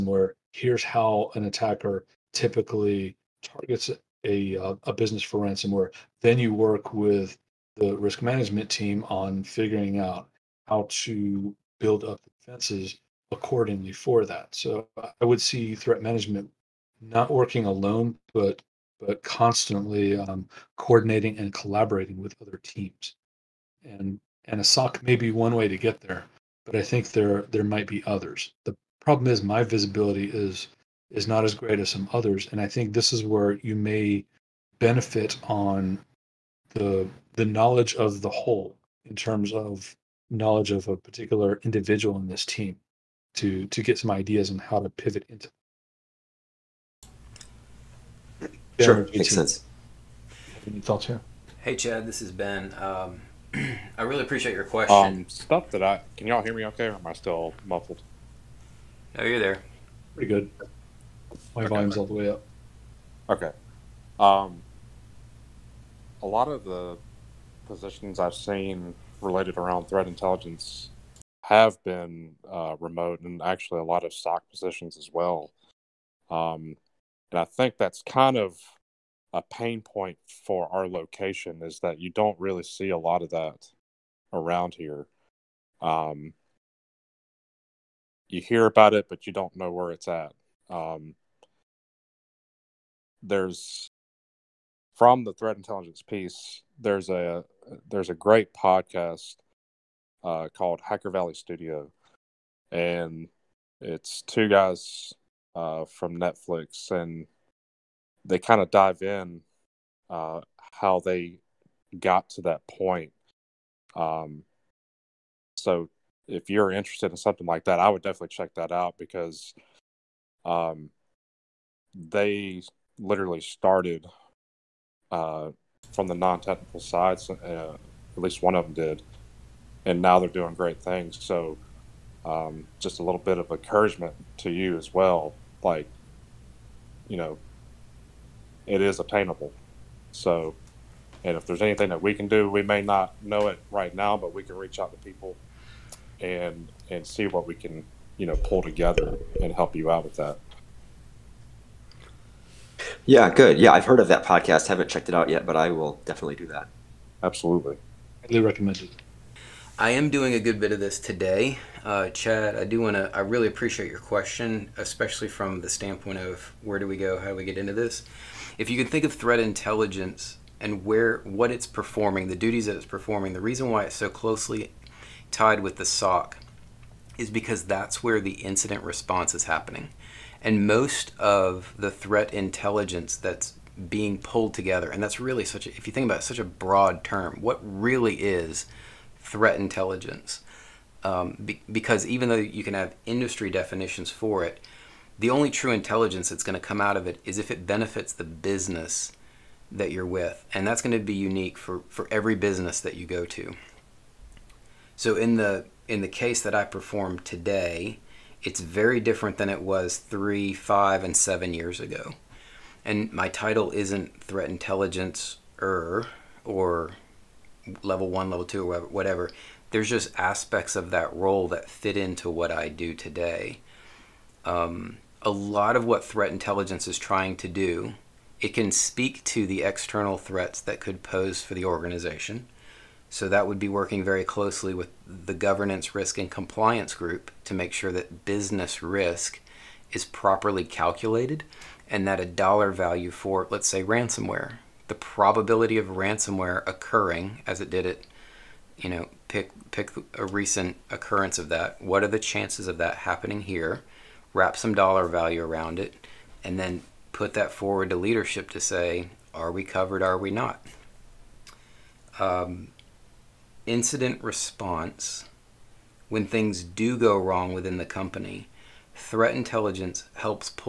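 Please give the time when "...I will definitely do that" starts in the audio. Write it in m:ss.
2:35.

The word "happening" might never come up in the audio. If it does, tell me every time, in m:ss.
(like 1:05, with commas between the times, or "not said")
2:59, 4:12.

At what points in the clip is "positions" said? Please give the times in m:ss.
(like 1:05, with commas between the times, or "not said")
1:07, 1:14.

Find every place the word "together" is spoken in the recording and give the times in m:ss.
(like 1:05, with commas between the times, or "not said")
2:28, 3:04.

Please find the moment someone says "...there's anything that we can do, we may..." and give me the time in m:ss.
2:21.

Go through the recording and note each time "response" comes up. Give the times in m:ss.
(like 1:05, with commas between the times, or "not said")
2:58, 4:24.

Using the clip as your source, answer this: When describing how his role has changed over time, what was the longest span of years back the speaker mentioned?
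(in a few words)
7 years.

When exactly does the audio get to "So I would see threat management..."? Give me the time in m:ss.
0:14.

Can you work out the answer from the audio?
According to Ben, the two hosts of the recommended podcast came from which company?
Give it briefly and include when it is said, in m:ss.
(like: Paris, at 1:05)
Netflix, at 1:46.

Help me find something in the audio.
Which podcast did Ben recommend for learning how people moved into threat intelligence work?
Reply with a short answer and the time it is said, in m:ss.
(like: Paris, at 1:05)
Hacker Valley Studio, at 1:40.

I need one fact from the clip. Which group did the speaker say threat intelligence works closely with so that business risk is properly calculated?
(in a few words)
governance risk and compliance.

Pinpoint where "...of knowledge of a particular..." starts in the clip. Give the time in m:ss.
0:39.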